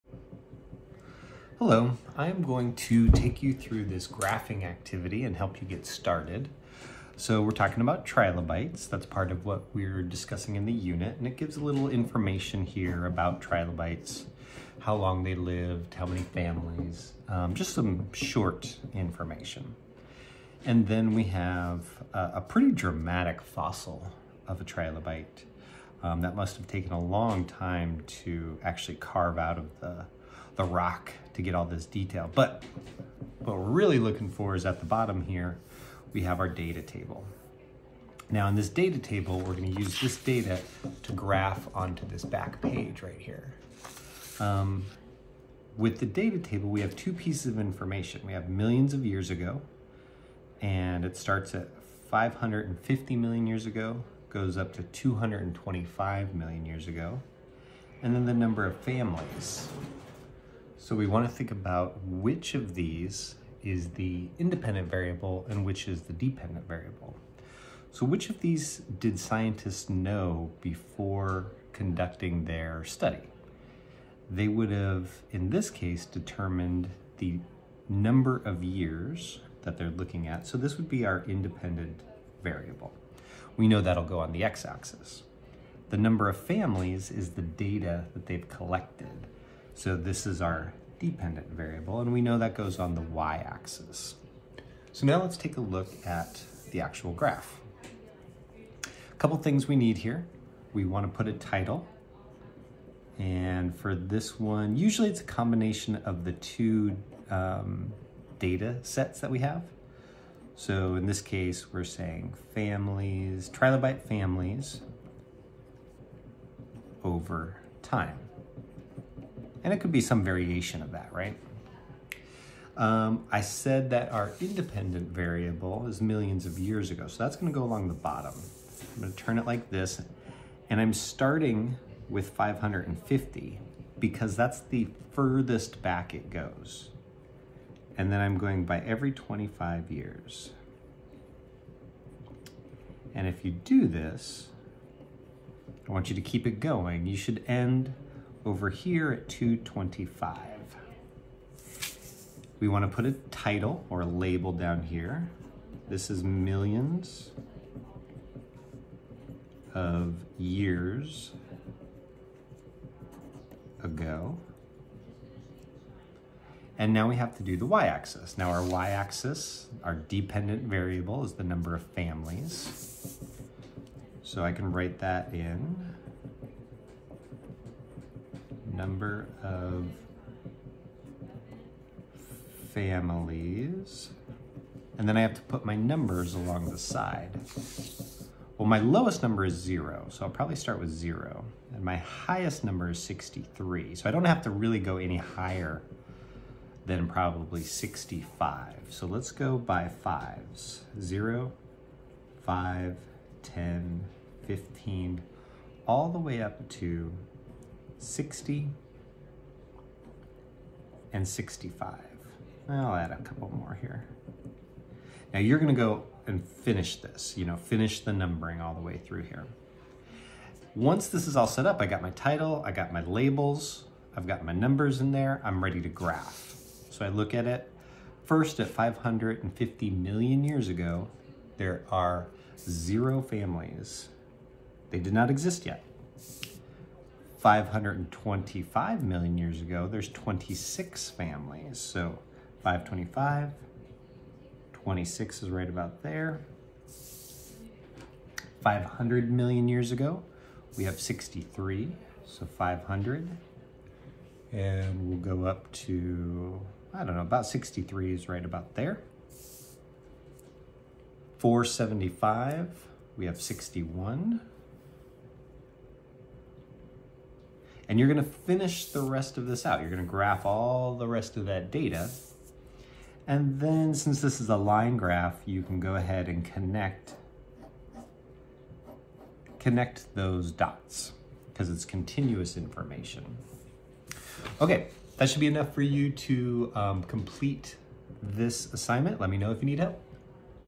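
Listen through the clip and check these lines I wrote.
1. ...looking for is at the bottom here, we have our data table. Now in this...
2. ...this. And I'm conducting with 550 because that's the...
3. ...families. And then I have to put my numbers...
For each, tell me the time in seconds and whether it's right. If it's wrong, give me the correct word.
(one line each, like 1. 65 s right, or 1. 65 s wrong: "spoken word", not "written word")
1. 33 s right
2. 129 s wrong: "starting", not "conducting"
3. 182 s right.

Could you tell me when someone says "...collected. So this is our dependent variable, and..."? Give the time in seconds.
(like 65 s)
88 s.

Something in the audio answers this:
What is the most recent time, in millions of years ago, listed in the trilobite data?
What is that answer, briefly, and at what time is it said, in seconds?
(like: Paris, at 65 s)
225, at 54 s.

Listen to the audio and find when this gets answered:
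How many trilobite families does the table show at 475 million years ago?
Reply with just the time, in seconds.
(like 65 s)
261 s.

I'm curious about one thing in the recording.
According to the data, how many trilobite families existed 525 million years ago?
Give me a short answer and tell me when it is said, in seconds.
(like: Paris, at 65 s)
26, at 239 s.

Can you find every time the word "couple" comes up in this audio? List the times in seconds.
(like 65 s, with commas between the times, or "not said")
99 s, 213 s.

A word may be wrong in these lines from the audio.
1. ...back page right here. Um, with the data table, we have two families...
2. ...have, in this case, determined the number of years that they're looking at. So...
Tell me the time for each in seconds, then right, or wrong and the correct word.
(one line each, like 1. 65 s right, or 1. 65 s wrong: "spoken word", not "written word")
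1. 42 s wrong: "pieces", not "families"
2. 74 s right.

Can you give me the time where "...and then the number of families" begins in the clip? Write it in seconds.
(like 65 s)
58 s.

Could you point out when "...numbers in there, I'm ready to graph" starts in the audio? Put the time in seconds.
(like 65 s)
224 s.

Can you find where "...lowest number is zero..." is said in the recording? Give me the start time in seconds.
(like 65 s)
188 s.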